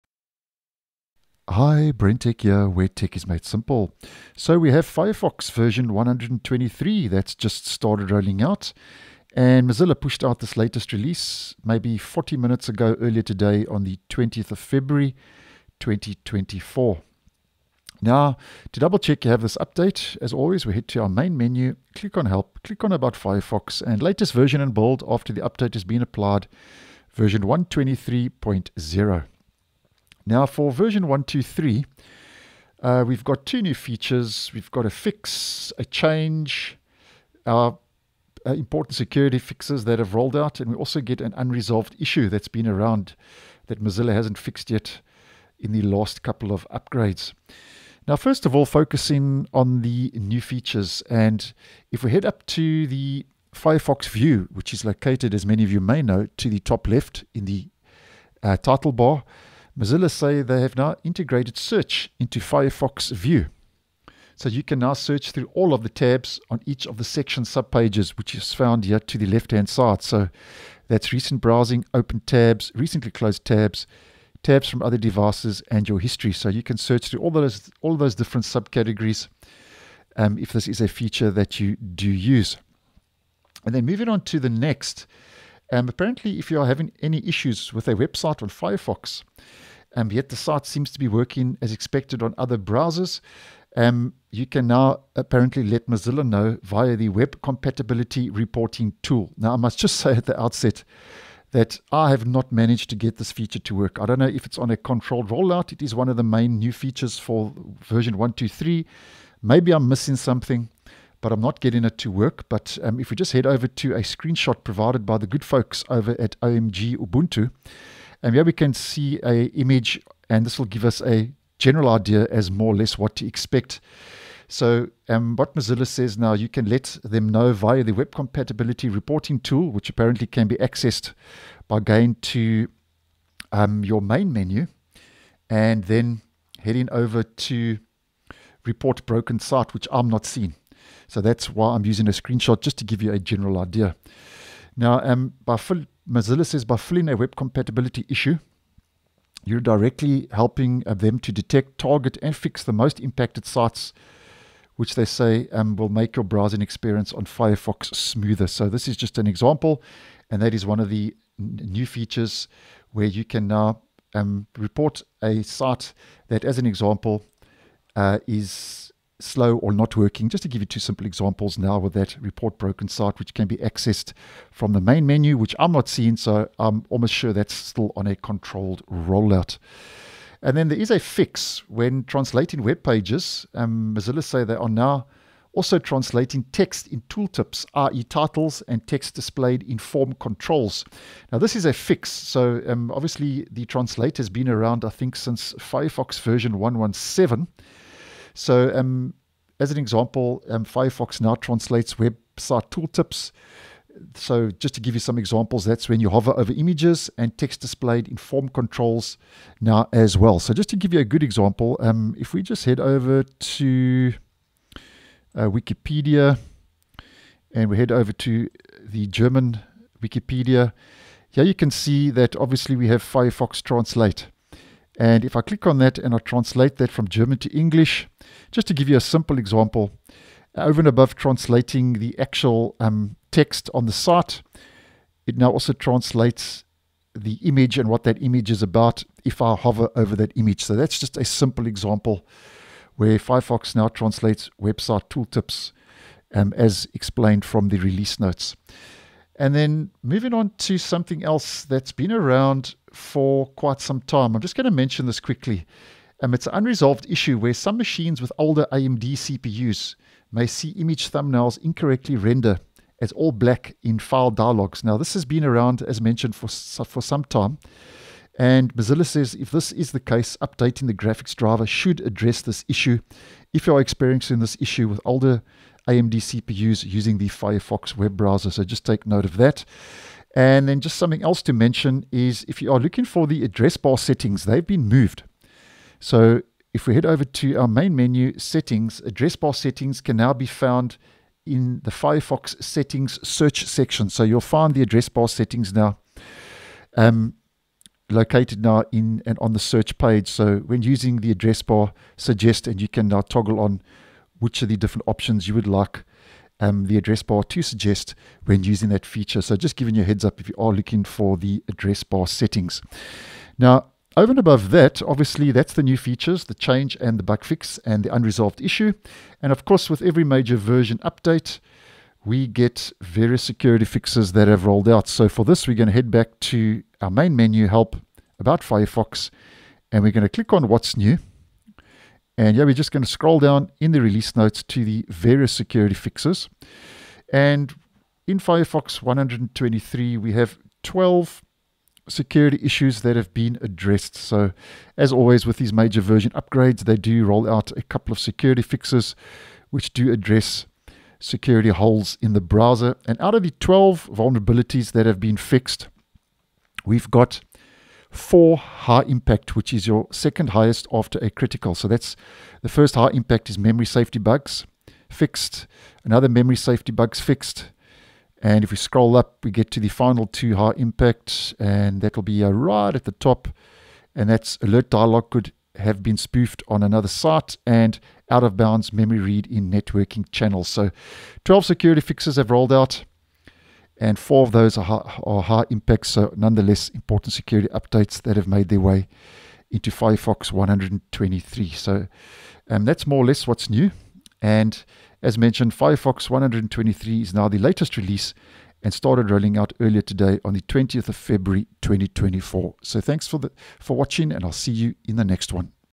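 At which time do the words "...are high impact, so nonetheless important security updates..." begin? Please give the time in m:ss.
6:25.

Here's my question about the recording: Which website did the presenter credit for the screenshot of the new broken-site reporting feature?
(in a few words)
OMG Ubuntu.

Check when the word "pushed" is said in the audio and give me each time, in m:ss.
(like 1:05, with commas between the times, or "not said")
0:09.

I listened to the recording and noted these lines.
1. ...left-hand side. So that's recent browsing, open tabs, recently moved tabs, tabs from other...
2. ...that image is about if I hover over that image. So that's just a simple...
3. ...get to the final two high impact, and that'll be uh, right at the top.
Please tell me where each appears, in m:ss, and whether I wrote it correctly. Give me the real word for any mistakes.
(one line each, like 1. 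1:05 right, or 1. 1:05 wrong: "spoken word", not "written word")
1. 1:09 wrong: "closed", not "moved"
2. 3:58 right
3. 6:09 right.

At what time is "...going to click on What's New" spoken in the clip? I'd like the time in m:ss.
5:30.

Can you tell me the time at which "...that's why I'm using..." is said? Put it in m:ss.
2:21.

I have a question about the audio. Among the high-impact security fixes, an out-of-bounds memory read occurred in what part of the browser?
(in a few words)
networking channels.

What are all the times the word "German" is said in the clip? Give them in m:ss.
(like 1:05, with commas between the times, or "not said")
3:39, 3:47.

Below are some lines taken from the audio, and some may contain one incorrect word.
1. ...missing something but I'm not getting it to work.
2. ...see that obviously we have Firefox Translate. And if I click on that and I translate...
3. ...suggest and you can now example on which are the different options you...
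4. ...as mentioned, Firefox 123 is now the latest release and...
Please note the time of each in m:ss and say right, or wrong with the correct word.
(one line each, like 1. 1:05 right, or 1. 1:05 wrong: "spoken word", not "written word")
1. 1:49 right
2. 3:41 right
3. 5:02 wrong: "toggle", not "example"
4. 6:35 right.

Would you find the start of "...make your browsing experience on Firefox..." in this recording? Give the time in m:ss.
2:35.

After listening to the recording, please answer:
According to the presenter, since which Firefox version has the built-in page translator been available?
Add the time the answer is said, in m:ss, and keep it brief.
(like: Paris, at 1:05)
117, at 3:16.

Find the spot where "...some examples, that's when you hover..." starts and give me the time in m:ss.
3:24.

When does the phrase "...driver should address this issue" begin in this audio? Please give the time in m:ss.
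4:31.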